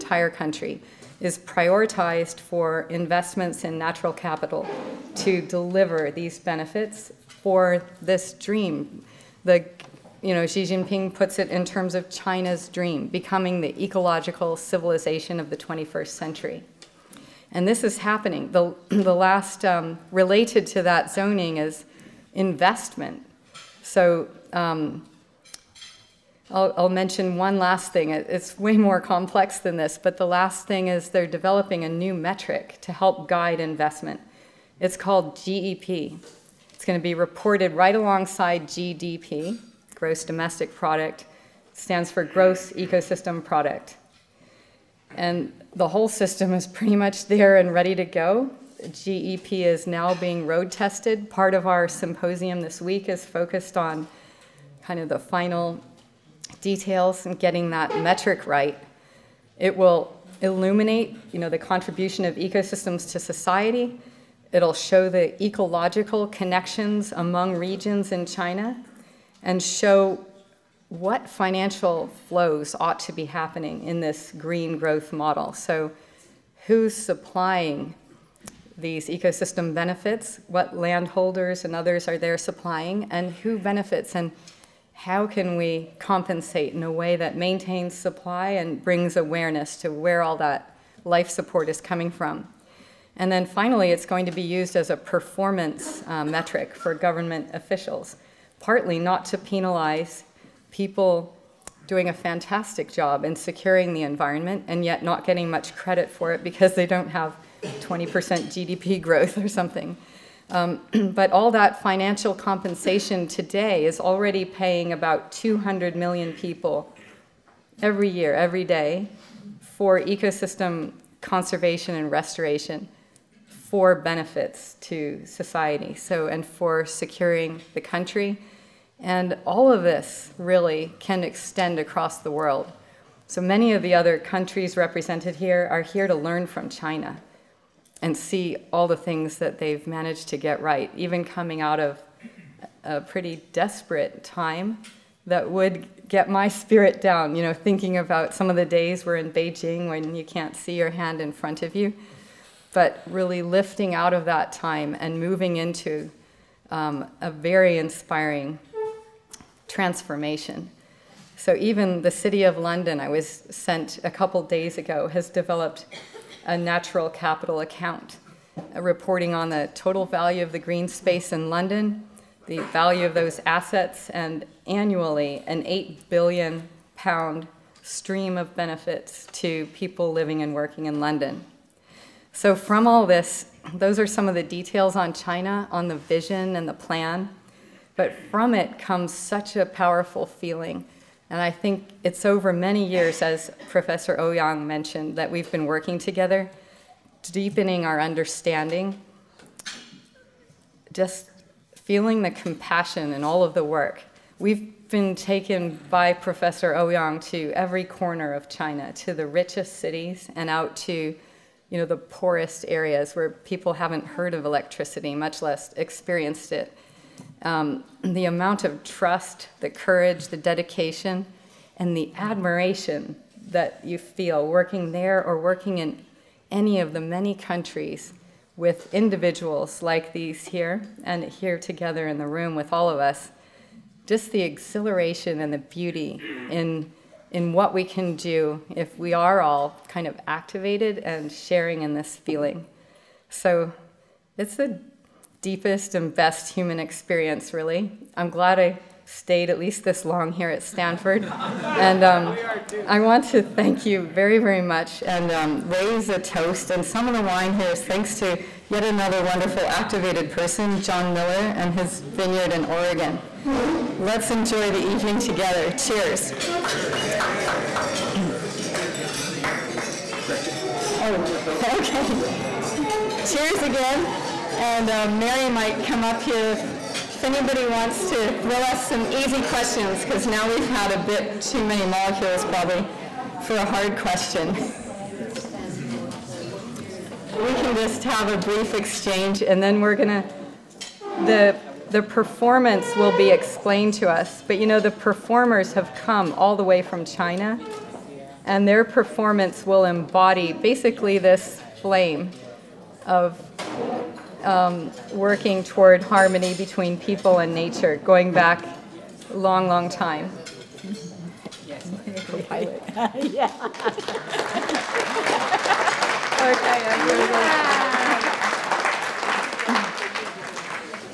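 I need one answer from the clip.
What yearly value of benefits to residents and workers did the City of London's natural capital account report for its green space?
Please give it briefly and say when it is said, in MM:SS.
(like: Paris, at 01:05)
8 billion pounds, at 02:55.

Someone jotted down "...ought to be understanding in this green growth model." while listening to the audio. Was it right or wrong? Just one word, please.
wrong.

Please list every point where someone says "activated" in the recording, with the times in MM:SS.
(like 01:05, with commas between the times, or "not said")
04:00, 04:19.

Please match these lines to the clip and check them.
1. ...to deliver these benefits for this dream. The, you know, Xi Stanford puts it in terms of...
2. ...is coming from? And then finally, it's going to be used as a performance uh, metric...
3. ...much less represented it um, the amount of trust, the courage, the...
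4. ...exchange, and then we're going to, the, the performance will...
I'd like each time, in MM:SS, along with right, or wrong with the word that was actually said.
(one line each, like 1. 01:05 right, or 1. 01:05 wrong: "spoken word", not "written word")
1. 00:05 wrong: "Jinping", not "Stanford"
2. 01:31 right
3. 03:35 wrong: "experienced", not "represented"
4. 04:48 right.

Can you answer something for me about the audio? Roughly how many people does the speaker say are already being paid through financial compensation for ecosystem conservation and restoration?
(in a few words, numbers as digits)
200 million.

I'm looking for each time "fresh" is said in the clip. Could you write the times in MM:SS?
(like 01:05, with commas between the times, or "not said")
not said.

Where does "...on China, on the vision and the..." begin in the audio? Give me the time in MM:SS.
03:04.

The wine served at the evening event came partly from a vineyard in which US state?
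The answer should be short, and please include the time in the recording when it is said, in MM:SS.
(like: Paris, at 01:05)
Oregon, at 04:22.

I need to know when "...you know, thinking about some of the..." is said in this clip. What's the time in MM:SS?
02:27.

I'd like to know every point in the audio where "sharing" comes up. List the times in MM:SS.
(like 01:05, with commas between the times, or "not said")
04:01.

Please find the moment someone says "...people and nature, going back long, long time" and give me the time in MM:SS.
05:06.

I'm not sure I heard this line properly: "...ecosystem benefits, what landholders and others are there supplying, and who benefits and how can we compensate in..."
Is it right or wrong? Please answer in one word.
right.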